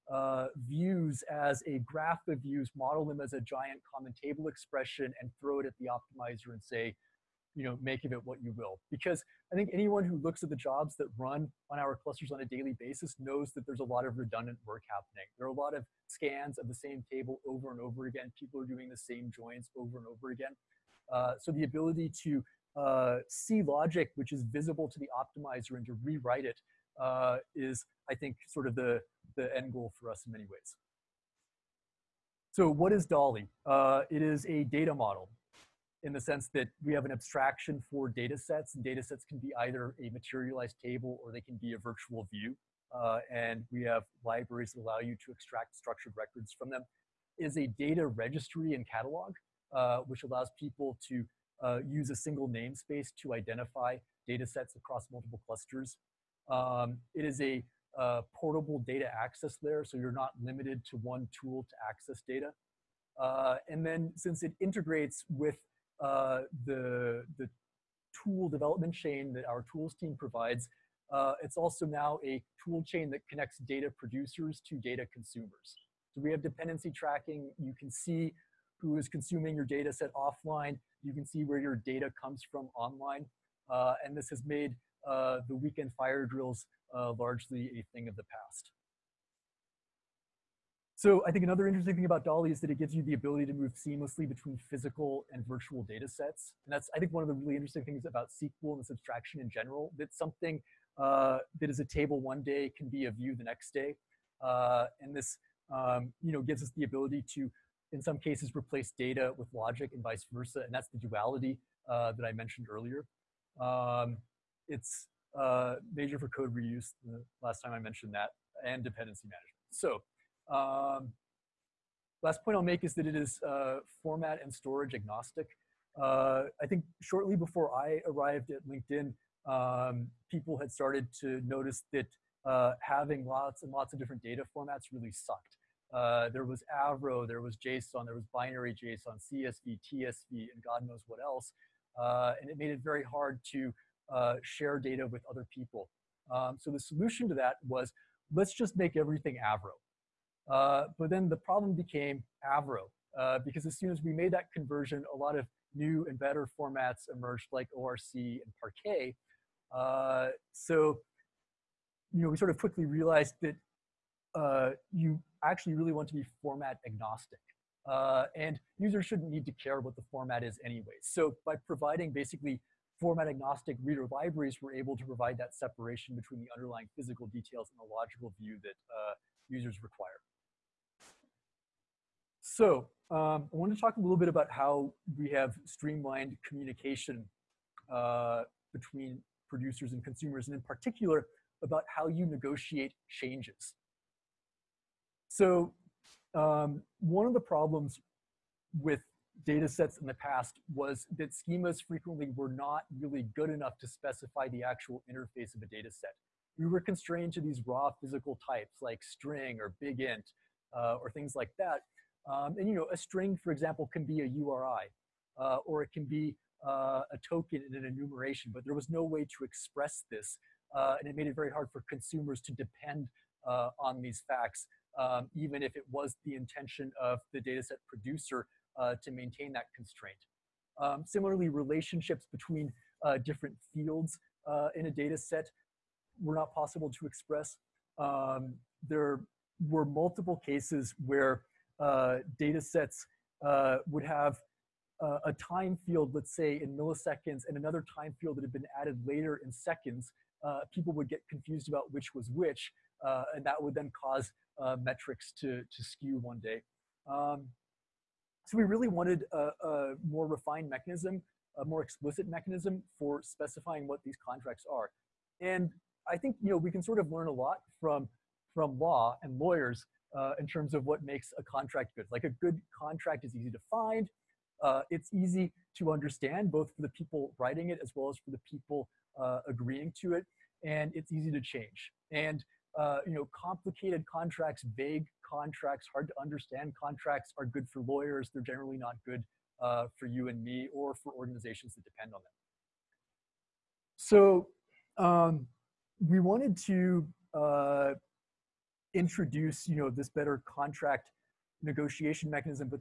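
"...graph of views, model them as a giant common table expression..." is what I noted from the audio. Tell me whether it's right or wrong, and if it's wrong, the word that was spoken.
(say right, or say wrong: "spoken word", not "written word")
right.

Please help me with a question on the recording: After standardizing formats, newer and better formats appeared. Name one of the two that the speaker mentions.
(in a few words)
ORC.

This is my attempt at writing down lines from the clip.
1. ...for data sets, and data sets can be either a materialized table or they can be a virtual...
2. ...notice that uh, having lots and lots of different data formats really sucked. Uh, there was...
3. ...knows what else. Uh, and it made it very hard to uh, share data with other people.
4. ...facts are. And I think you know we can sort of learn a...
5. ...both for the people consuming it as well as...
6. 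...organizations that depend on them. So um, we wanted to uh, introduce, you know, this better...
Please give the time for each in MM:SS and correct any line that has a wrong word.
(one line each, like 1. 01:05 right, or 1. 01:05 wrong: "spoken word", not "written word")
1. 00:37 right
2. 02:11 right
3. 02:20 right
4. 04:24 wrong: "contracts", not "facts"
5. 04:36 wrong: "writing", not "consuming"
6. 04:51 right.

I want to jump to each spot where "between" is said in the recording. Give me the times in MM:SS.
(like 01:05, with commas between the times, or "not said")
01:34, 02:56, 03:08, 03:52.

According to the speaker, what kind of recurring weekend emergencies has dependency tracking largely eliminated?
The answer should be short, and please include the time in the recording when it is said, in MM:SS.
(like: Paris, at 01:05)
fire drills, at 01:25.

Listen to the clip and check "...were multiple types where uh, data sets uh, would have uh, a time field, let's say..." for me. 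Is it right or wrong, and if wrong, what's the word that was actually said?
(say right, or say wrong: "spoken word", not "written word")
wrong: "cases", not "types".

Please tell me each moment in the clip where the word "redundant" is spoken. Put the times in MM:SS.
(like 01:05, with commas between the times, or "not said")
00:14.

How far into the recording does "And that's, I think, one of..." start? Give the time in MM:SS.
01:36.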